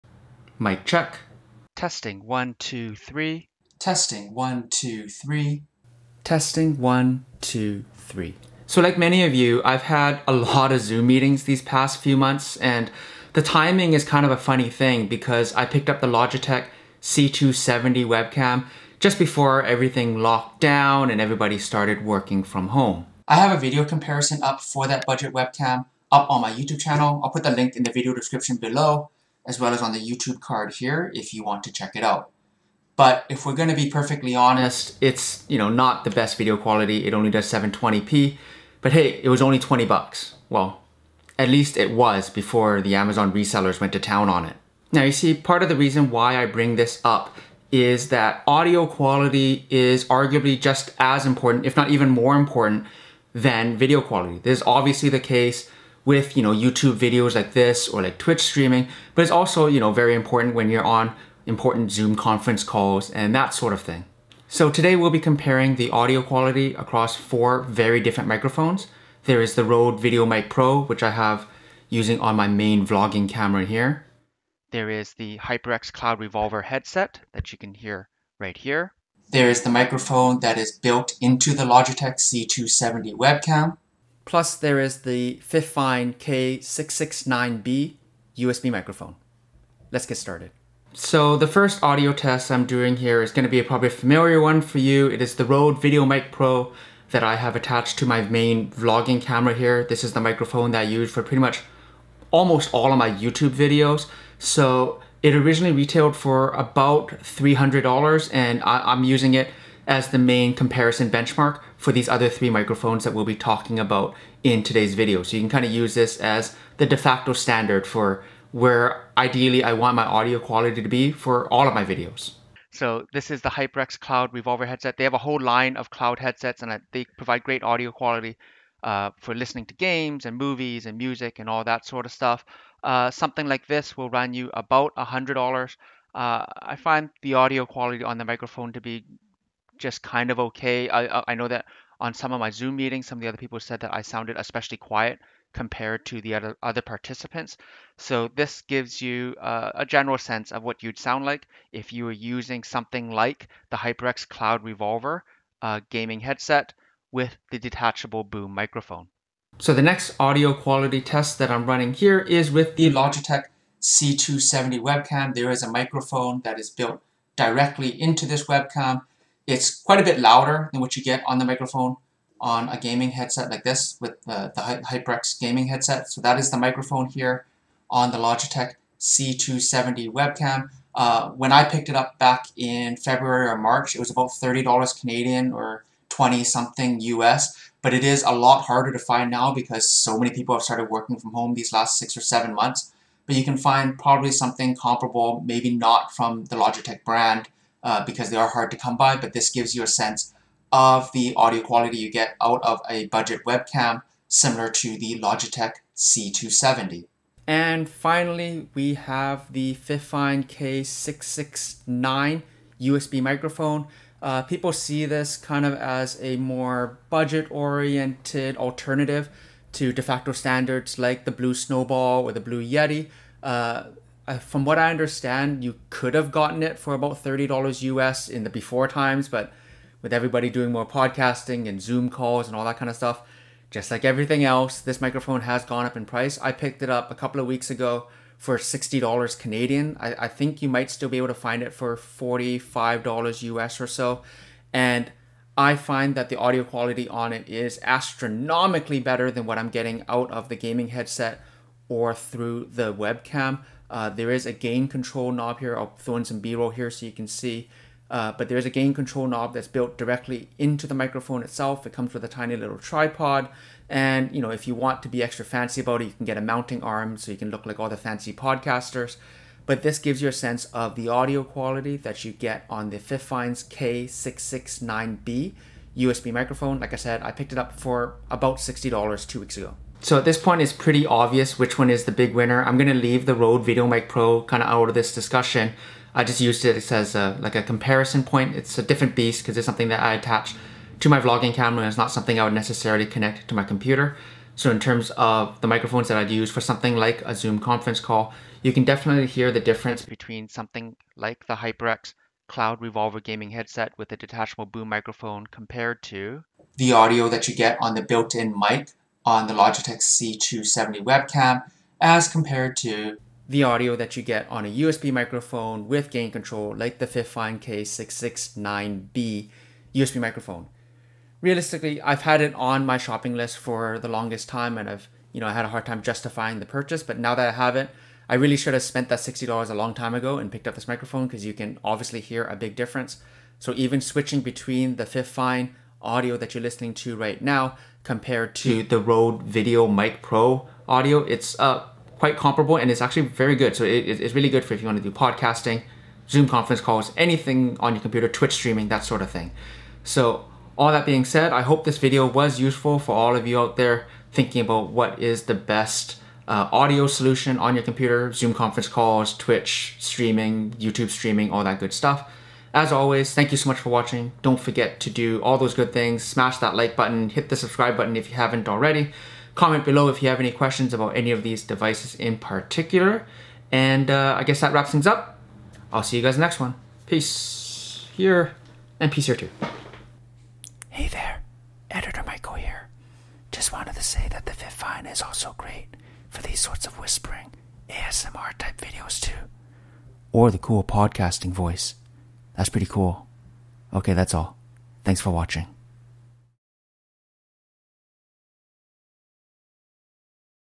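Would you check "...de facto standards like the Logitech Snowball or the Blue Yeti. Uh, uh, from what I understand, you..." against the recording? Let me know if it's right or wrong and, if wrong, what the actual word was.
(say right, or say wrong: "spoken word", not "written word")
wrong: "Blue", not "Logitech".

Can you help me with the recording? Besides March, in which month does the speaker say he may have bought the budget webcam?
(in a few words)
February.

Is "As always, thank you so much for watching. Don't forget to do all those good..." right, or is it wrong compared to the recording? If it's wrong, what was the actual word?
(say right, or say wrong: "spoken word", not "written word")
right.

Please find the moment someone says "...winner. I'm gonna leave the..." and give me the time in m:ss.
4:42.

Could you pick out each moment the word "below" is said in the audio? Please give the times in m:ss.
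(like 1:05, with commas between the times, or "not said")
0:28, 6:09.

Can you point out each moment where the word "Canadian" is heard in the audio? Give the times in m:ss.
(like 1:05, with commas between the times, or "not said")
3:04, 3:59.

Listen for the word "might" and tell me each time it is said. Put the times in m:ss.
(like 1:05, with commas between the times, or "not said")
4:00.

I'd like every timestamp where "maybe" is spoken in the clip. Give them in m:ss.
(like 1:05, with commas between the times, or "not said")
3:15.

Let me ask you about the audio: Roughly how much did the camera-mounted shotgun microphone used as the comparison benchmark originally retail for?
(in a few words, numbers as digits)
$300.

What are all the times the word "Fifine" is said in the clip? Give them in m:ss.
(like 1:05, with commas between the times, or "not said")
1:25, 3:29, 4:32, 5:17, 5:35, 6:24.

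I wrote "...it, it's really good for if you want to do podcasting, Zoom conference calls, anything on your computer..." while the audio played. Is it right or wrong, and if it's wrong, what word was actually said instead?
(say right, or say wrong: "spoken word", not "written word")
right.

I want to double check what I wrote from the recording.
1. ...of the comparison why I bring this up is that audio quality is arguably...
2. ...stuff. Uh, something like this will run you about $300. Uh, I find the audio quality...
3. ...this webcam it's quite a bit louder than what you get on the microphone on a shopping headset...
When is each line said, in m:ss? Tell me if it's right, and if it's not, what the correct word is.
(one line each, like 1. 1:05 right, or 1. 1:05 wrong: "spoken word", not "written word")
1. 0:45 wrong: "reason", not "comparison"
2. 2:12 wrong: "100", not "300"
3. 2:48 wrong: "gaming", not "shopping".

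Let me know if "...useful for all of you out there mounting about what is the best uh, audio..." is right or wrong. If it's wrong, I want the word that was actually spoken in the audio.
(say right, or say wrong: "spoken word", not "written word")
wrong: "thinking", not "mounting".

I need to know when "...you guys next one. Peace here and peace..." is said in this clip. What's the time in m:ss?
6:16.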